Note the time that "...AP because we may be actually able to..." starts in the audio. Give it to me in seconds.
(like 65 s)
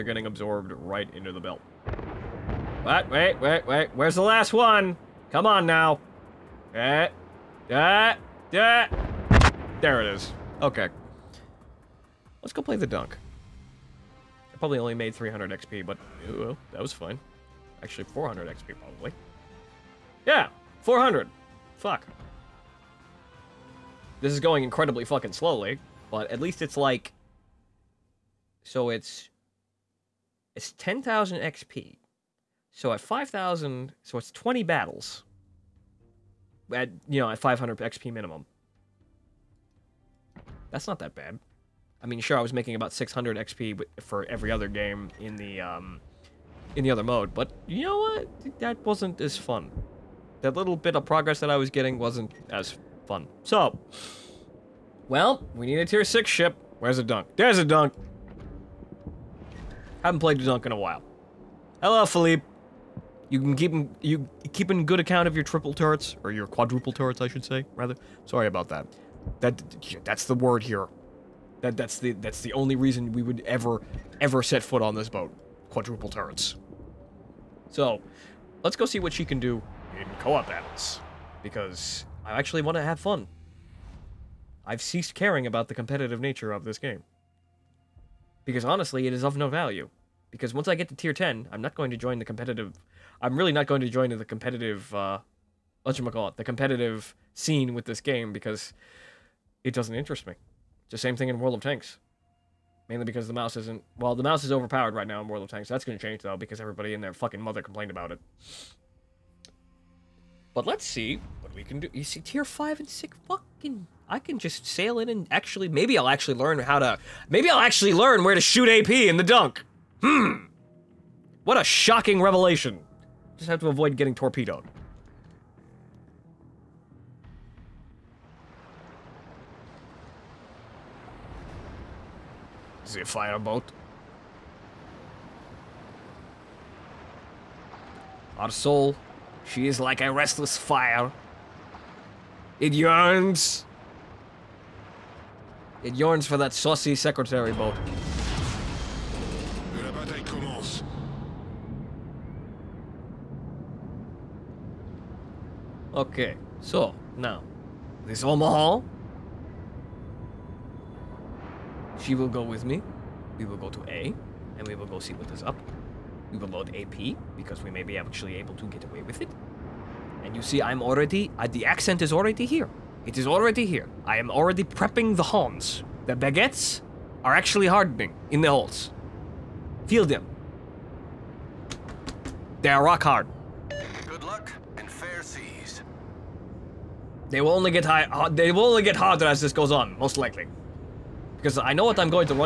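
166 s.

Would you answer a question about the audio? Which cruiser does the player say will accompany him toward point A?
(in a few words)
Omaha.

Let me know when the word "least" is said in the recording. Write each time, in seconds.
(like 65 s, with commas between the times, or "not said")
26 s.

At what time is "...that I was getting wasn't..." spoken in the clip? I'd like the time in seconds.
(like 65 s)
51 s.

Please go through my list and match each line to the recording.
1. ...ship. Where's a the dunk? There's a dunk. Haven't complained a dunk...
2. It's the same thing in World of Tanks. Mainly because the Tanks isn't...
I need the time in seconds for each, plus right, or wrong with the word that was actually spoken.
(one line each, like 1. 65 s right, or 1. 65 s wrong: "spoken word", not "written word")
1. 56 s wrong: "played", not "complained"
2. 100 s wrong: "Maus", not "Tanks".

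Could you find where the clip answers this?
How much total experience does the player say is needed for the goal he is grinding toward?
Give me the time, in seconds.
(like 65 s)
30 s.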